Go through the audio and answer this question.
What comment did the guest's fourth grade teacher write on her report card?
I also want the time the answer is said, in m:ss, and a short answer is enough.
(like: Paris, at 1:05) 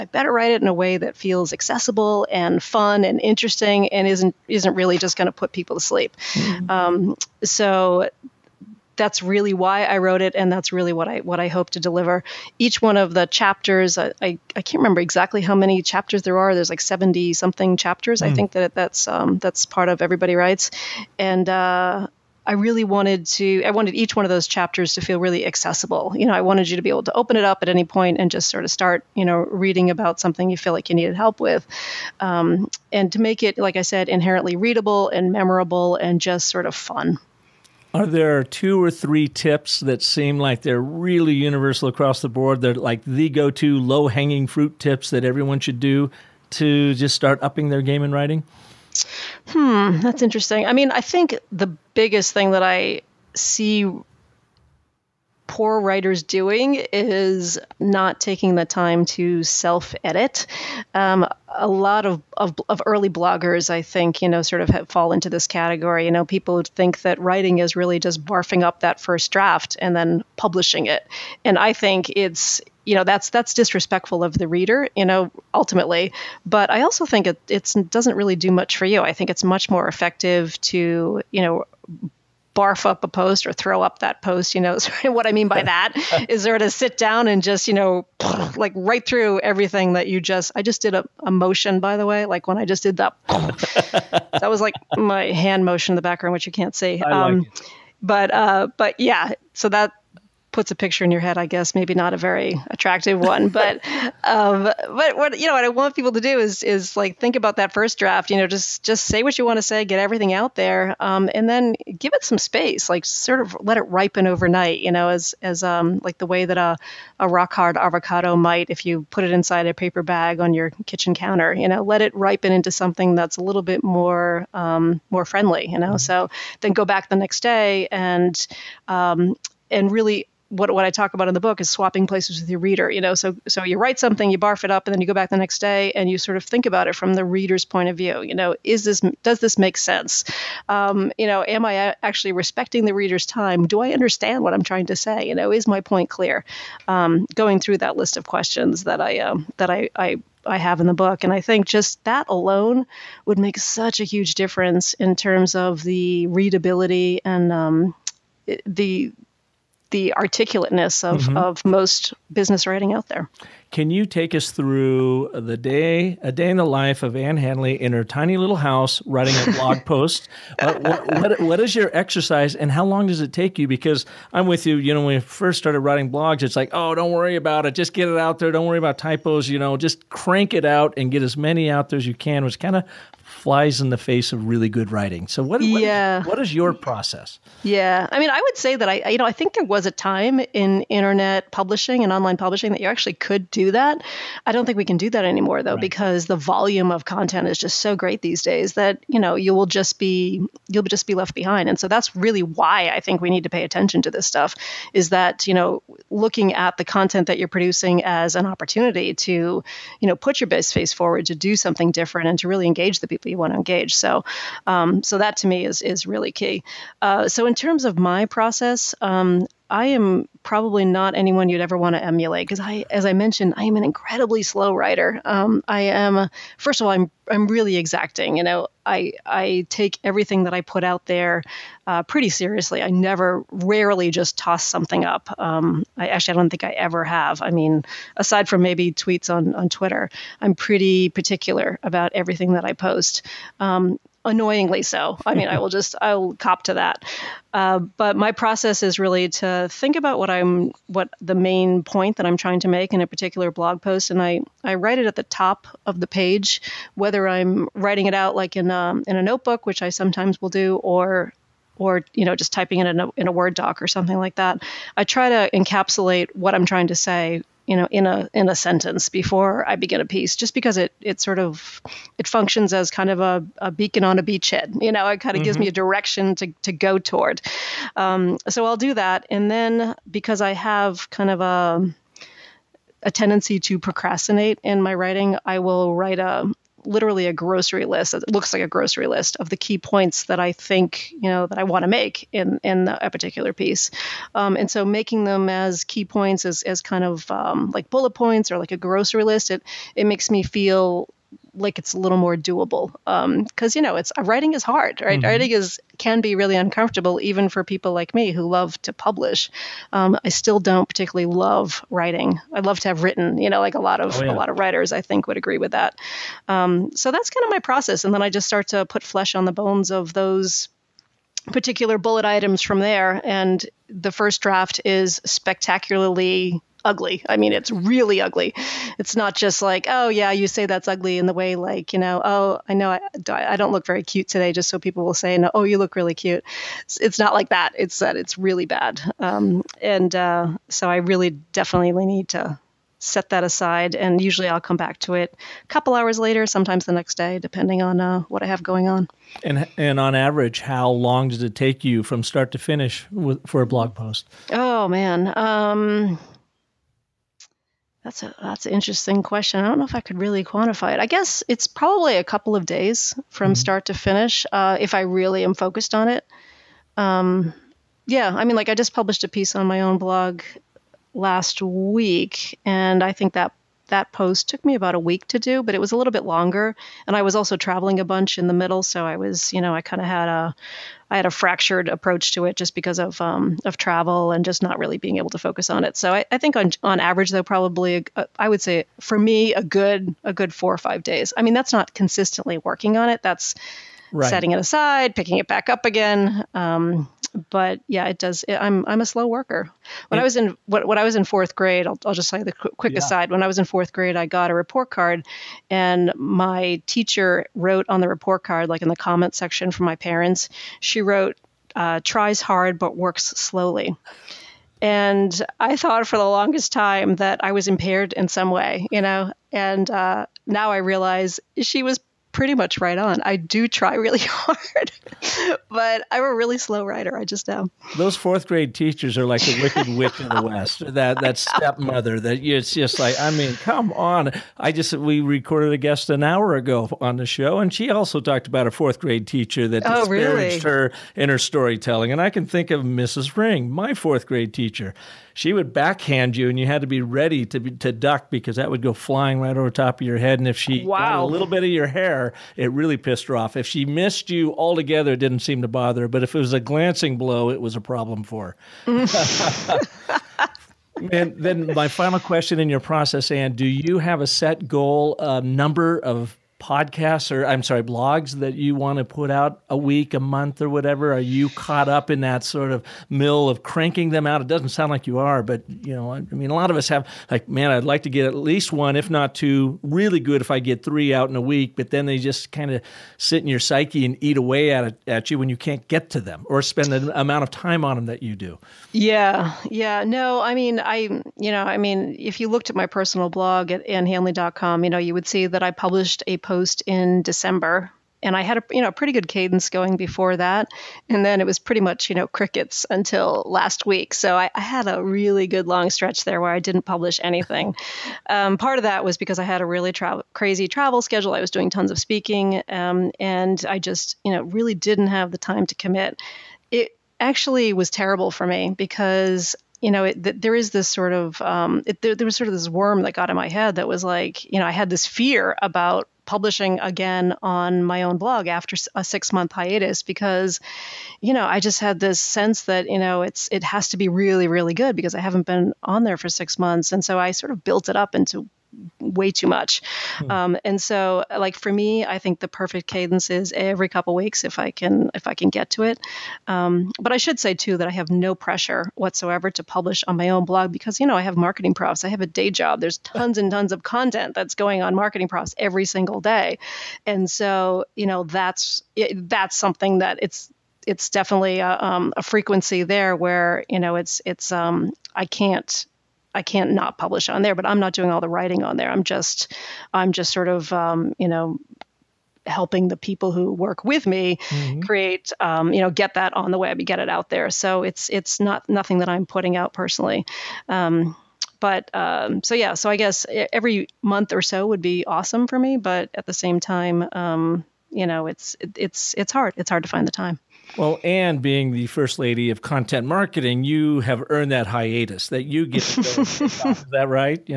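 Tries hard but works slowly, at 6:52.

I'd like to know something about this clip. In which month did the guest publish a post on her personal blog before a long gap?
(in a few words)
December.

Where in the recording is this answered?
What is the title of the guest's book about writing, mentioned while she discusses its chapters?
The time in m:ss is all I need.
0:19.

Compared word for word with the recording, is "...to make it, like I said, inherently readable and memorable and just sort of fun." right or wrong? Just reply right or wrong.
right.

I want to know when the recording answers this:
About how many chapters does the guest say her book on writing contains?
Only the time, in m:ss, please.
0:16.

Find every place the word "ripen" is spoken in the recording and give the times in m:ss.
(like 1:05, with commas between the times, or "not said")
1:53, 2:02.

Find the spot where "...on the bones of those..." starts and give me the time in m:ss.
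5:19.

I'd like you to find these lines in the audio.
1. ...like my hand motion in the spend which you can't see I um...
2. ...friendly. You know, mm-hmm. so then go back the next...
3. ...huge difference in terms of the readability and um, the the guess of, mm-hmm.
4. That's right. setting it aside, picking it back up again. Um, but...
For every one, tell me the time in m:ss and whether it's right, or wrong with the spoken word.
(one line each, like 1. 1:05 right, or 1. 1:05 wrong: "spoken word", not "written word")
1. 1:34 wrong: "background", not "spend"
2. 2:05 right
3. 2:34 wrong: "articulateness", not "guess"
4. 6:33 right.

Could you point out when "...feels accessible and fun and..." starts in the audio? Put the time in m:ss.
0:01.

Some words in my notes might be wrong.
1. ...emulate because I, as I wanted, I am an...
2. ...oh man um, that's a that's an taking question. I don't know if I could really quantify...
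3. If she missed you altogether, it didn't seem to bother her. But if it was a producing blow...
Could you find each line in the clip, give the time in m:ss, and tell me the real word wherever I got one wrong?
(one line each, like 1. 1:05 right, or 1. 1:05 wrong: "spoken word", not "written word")
1. 3:42 wrong: "mentioned", not "wanted"
2. 5:54 wrong: "interesting", not "taking"
3. 7:33 wrong: "glancing", not "producing".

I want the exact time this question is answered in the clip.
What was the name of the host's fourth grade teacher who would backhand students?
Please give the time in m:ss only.
7:22.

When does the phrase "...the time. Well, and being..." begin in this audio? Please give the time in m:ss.
9:50.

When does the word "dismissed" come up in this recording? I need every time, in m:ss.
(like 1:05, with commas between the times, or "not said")
not said.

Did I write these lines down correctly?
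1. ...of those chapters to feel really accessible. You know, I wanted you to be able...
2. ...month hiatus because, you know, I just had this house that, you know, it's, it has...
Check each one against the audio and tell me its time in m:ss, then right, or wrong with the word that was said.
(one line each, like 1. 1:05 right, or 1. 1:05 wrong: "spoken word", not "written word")
1. 0:24 right
2. 8:49 wrong: "sense", not "house".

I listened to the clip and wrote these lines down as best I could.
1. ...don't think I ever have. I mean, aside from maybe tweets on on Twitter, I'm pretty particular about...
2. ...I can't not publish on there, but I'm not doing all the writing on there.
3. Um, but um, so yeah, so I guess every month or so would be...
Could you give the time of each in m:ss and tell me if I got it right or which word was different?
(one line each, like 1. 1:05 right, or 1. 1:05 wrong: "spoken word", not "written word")
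1. 3:56 right
2. 9:26 right
3. 9:40 right.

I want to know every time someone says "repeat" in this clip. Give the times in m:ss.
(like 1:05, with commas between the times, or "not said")
not said.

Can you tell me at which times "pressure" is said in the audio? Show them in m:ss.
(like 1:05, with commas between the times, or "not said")
9:08.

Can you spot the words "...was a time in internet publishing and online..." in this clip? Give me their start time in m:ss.
3:09.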